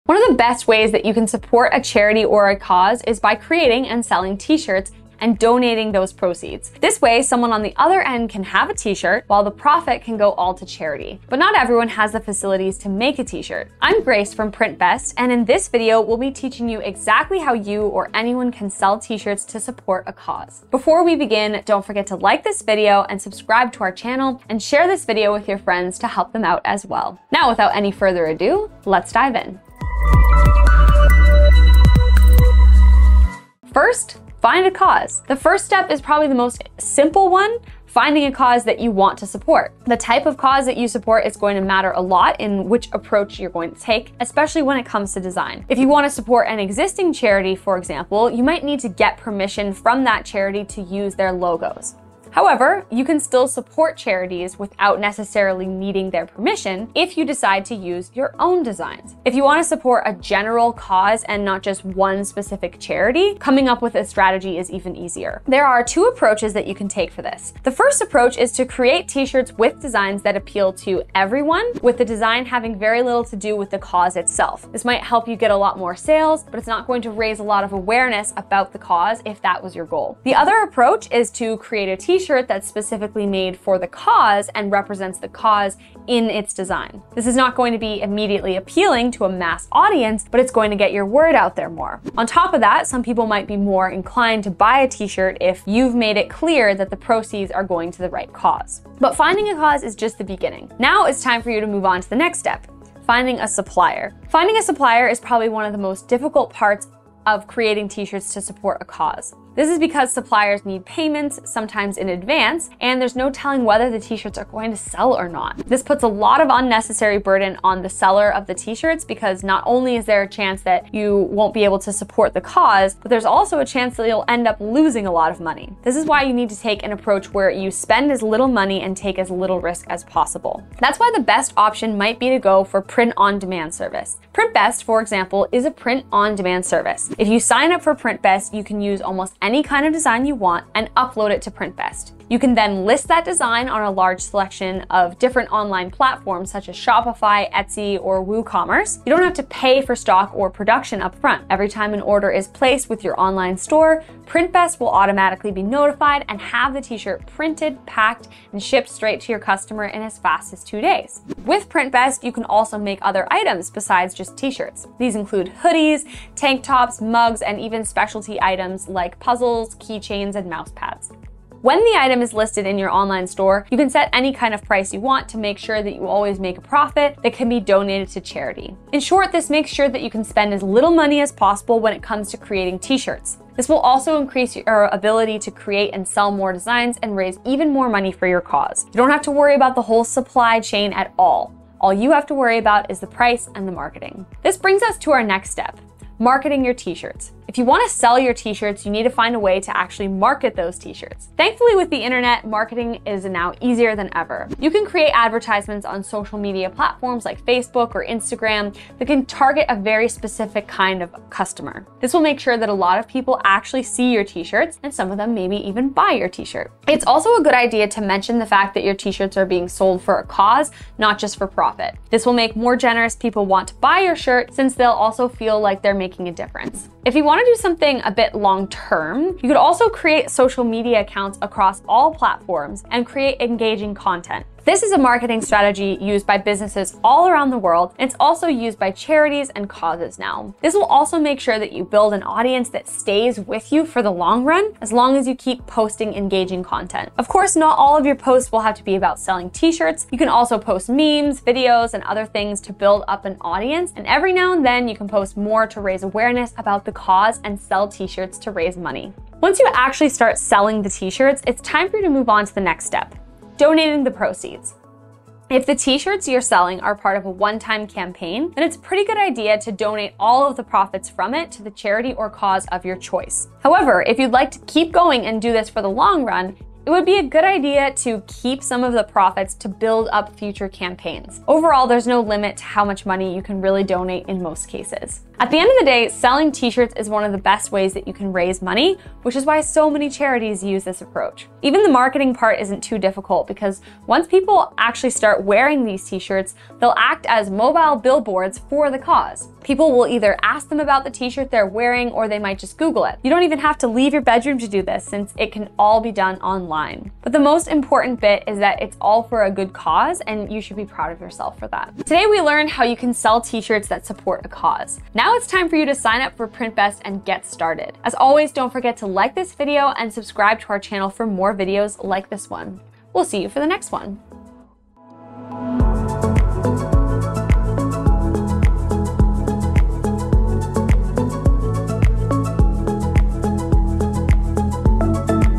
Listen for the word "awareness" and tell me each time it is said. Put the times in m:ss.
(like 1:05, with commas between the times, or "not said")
1:17, 4:16.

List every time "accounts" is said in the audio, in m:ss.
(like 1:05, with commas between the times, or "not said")
3:51.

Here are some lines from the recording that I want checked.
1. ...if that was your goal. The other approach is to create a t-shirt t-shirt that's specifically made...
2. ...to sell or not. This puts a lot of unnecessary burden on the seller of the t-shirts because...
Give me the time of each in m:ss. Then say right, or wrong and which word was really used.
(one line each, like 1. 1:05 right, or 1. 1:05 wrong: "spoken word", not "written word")
1. 1:19 right
2. 1:54 right.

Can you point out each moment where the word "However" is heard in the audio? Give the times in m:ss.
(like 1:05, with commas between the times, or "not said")
0:52, 4:33.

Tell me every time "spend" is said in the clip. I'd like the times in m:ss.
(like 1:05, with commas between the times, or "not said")
2:07, 3:00.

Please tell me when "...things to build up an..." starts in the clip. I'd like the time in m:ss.
4:12.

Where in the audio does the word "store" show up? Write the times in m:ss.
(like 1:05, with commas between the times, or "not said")
2:33, 2:53.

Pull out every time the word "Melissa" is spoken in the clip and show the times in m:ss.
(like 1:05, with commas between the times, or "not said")
not said.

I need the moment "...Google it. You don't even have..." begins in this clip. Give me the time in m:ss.
5:02.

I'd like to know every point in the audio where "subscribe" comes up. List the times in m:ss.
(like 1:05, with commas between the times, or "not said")
0:23, 5:20.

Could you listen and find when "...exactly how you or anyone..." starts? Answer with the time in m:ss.
0:16.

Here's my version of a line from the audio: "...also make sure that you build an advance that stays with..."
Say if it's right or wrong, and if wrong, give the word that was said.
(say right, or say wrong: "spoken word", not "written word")
wrong: "audience", not "advance".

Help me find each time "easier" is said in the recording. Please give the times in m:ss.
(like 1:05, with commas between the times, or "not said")
1:04, 3:23.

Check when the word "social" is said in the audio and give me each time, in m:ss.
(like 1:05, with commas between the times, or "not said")
3:26, 3:50.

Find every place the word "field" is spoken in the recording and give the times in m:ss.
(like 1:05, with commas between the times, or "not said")
not said.